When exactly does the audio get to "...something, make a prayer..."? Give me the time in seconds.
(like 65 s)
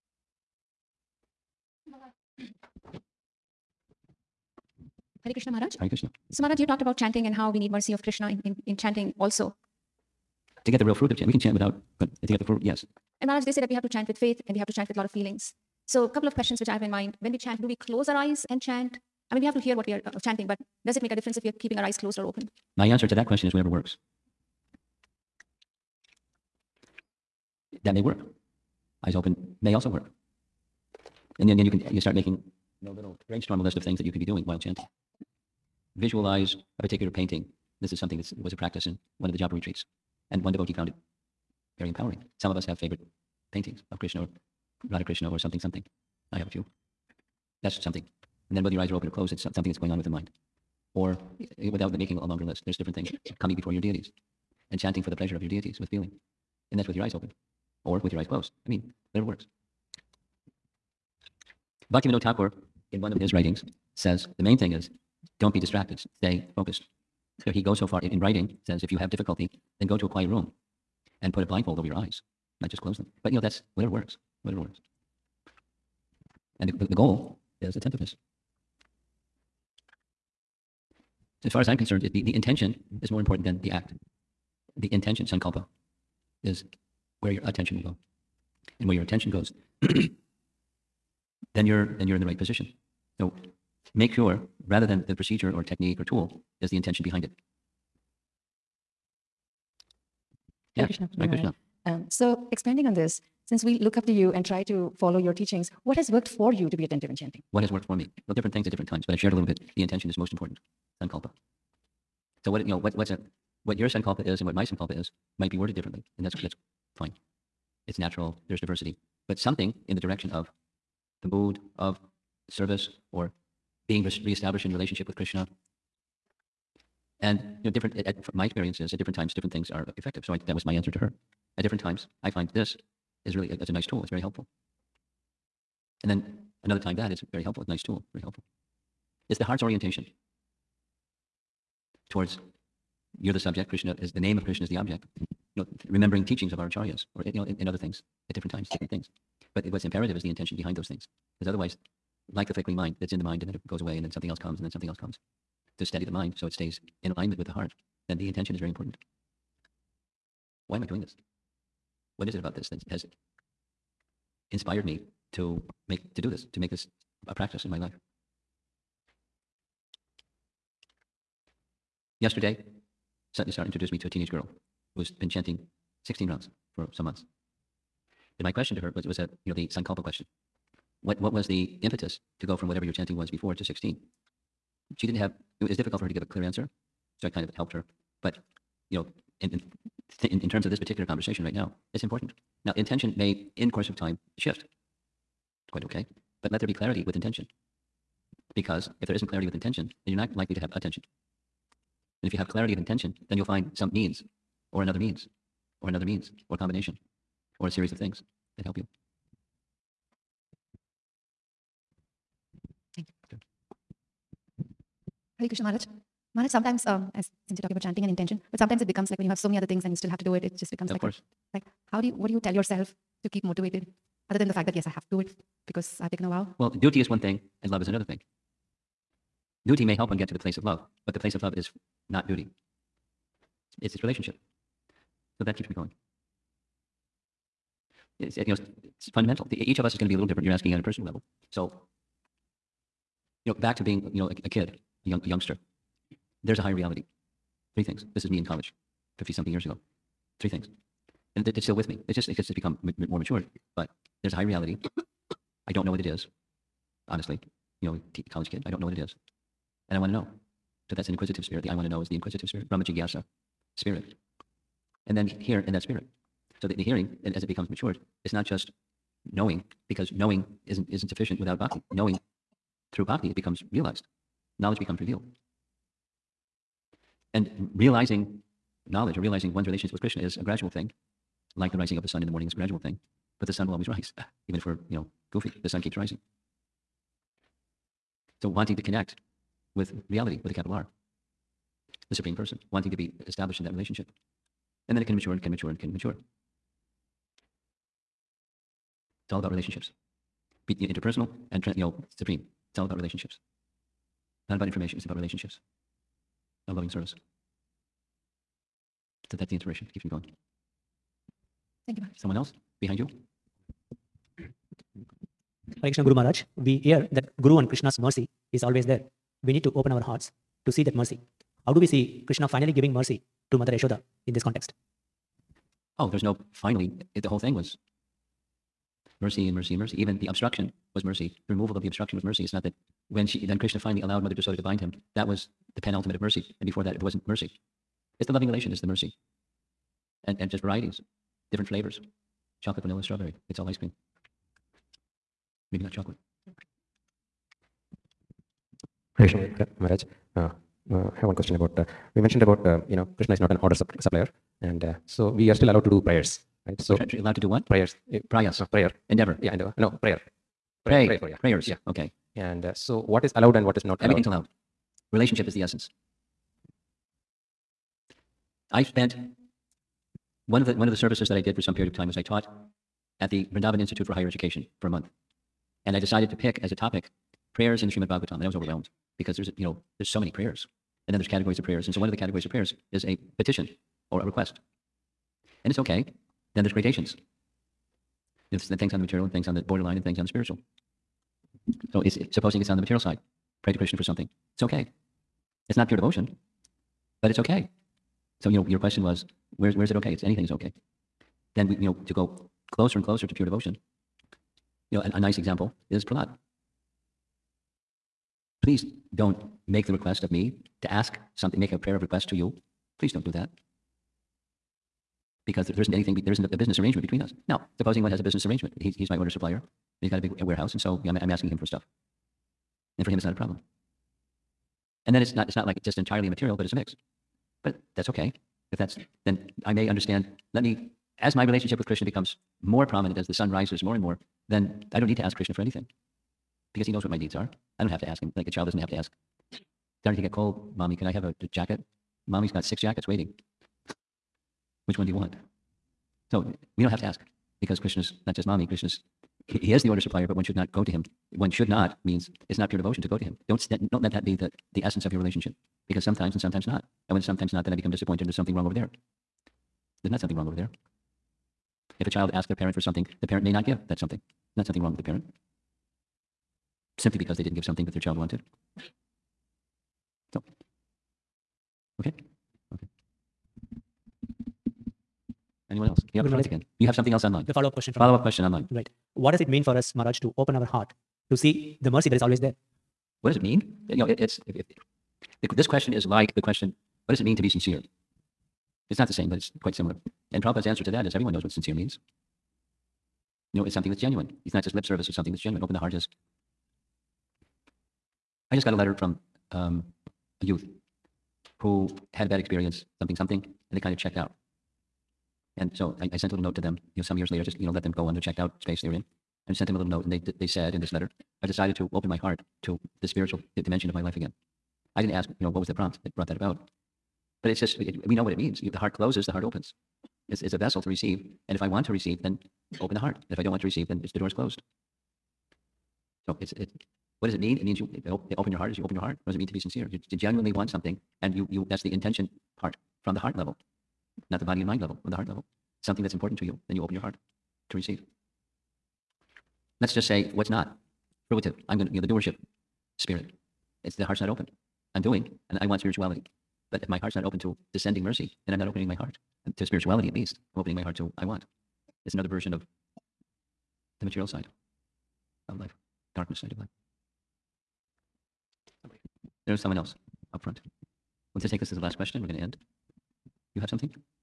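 411 s.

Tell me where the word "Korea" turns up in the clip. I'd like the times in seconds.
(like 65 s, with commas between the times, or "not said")
not said.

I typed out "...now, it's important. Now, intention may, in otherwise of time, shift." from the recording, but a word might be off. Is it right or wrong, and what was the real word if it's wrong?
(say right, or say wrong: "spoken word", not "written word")
wrong: "course", not "otherwise".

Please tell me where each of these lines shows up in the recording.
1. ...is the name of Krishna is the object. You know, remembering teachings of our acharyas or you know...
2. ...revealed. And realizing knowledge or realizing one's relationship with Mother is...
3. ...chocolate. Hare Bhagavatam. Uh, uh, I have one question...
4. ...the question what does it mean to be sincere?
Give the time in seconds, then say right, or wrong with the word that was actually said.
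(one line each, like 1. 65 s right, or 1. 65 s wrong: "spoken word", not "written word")
1. 143 s right
2. 274 s wrong: "Krishna", not "Mother"
3. 345 s wrong: "Maharaj", not "Bhagavatam"
4. 486 s right.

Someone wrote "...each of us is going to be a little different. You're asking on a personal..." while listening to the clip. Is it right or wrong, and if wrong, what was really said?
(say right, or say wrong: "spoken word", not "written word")
right.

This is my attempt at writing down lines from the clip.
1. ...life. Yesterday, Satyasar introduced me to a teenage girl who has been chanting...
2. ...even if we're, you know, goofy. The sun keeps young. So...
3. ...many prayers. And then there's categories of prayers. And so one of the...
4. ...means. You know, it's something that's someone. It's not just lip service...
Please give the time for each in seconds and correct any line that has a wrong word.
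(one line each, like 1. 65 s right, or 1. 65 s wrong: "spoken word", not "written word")
1. 167 s right
2. 284 s wrong: "rising", not "young"
3. 380 s right
4. 491 s wrong: "genuine", not "someone".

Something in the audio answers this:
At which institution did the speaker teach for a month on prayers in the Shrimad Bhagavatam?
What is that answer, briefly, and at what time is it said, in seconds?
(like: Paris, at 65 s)
Vrindavan Institute for Higher Education, at 373 s.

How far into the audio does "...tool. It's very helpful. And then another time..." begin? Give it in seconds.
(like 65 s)
133 s.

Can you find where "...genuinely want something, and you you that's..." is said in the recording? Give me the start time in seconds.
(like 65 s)
530 s.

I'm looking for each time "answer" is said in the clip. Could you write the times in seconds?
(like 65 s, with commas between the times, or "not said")
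22 s, 130 s, 186 s, 490 s.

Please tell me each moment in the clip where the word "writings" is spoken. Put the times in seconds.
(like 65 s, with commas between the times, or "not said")
63 s, 68 s.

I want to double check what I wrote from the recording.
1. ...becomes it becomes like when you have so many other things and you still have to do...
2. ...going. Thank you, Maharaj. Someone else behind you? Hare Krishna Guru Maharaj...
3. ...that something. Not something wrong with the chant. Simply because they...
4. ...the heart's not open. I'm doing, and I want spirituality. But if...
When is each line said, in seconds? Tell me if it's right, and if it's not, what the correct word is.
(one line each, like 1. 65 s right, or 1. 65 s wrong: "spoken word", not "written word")
1. 218 s wrong: "sometimes", not "becomes"
2. 310 s right
3. 463 s wrong: "parent", not "chant"
4. 543 s right.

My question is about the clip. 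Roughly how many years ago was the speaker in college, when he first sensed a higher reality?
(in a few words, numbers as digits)
50 something.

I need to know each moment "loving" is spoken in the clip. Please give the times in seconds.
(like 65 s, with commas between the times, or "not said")
306 s, 338 s.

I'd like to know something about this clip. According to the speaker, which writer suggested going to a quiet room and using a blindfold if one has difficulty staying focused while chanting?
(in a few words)
Bhaktivinoda Thakur.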